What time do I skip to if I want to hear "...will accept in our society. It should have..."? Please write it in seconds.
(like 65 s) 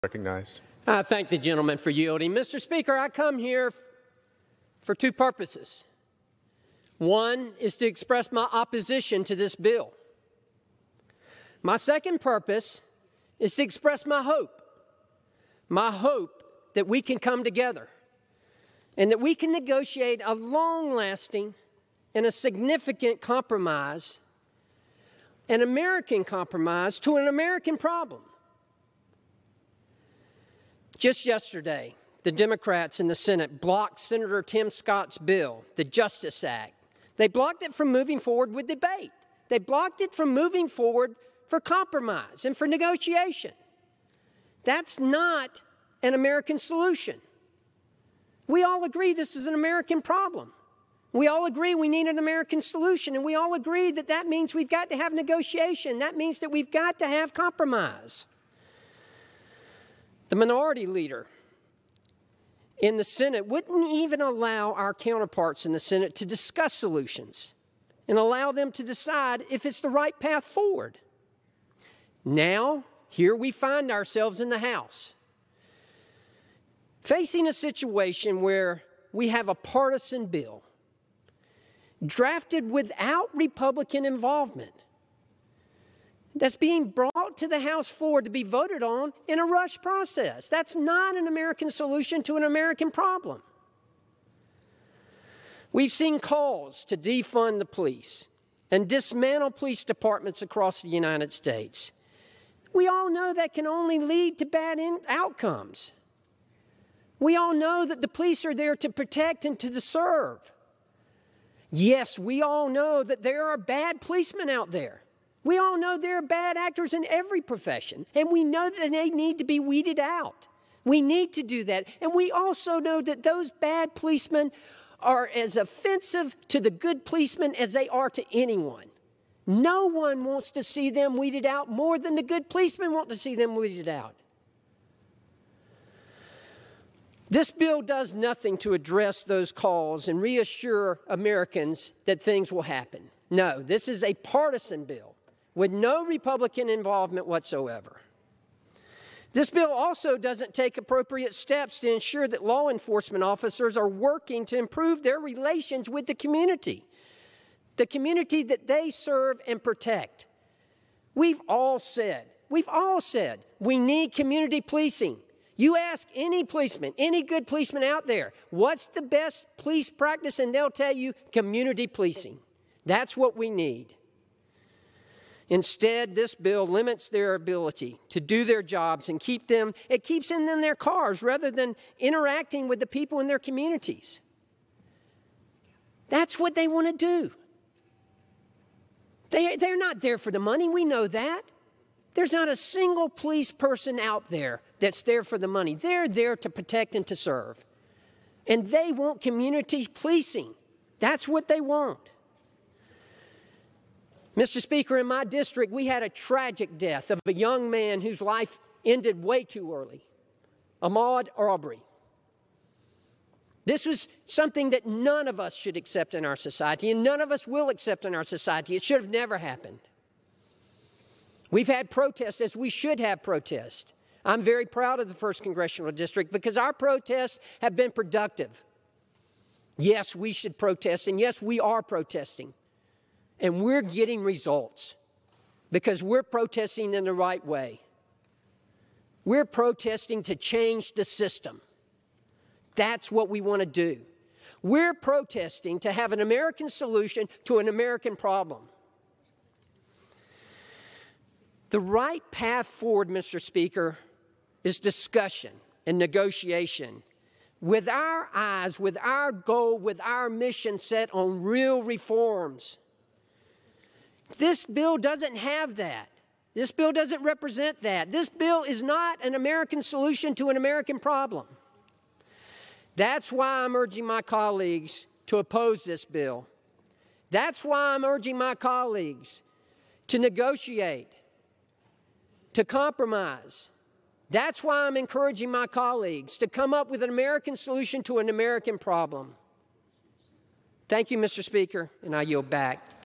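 217 s.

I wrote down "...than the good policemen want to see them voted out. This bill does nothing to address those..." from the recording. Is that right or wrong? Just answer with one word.
wrong.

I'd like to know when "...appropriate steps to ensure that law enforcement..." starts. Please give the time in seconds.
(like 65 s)
150 s.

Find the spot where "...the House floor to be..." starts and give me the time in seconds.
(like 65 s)
87 s.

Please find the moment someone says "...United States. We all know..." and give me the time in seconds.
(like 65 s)
100 s.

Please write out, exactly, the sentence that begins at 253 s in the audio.
Speaker, is discussion and negotiation with our eyes, with our goal, with our mission set on real reforms.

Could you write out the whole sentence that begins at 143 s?
No, this is a partisan bill with no Republican involvement whatsoever.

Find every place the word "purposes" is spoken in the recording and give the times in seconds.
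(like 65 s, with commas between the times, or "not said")
5 s, 12 s.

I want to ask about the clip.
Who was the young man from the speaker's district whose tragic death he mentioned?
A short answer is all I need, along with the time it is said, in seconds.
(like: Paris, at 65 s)
Ahmaud Arbery, at 210 s.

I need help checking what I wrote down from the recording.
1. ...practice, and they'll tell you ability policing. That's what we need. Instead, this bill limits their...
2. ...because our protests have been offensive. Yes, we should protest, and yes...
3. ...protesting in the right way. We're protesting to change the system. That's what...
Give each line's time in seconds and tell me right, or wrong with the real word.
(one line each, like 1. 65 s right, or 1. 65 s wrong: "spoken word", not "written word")
1. 169 s wrong: "community", not "ability"
2. 226 s wrong: "productive", not "offensive"
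3. 236 s right.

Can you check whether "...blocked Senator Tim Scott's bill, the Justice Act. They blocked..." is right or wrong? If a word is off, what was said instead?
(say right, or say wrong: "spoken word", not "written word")
right.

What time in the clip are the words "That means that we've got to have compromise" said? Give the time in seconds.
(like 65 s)
55 s.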